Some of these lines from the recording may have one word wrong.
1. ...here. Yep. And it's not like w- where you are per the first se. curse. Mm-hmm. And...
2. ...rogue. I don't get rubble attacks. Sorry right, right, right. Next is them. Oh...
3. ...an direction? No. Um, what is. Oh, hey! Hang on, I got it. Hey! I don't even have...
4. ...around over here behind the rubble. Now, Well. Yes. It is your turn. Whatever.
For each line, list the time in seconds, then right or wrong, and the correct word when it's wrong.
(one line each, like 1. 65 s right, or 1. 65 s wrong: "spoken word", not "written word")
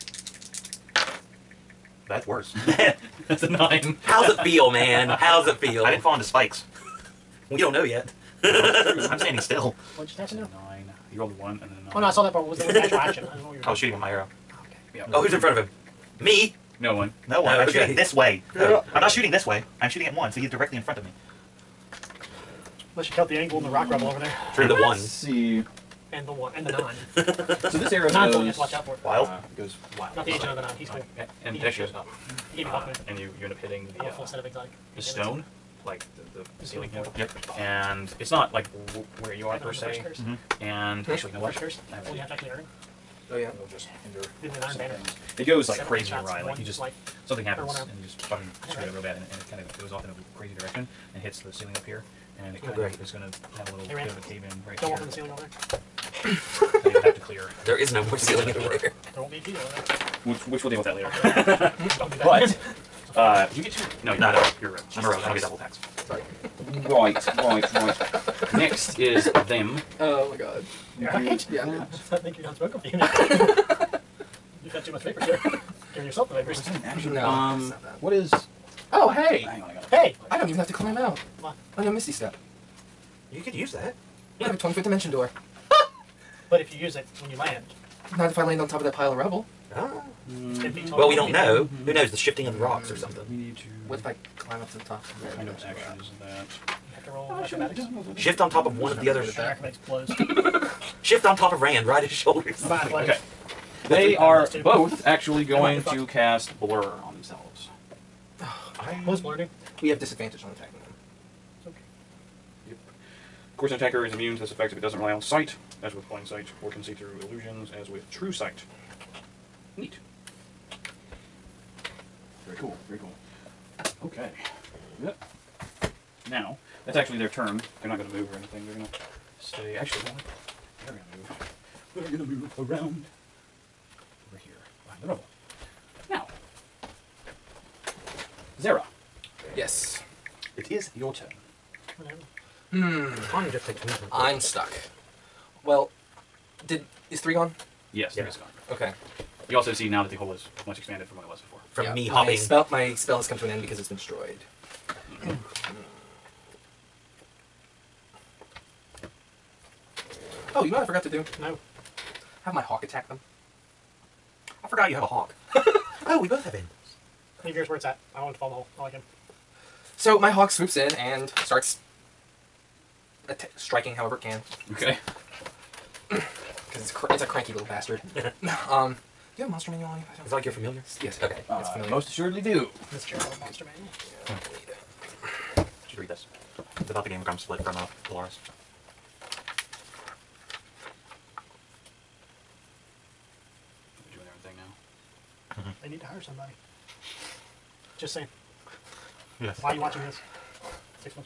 1. 36 s right
2. 65 s wrong: "double", not "rubble"
3. 76 s wrong: "action", not "direction"
4. 132 s wrong: "Zera", not "Well".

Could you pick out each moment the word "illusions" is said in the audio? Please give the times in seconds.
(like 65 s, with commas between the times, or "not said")
117 s.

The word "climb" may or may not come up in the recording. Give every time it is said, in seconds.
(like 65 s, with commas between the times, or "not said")
80 s, 94 s.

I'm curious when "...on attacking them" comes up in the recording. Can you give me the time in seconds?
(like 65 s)
110 s.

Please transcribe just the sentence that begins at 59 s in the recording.
There won't be a key over there.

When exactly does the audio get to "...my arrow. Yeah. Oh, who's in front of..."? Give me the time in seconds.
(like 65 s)
13 s.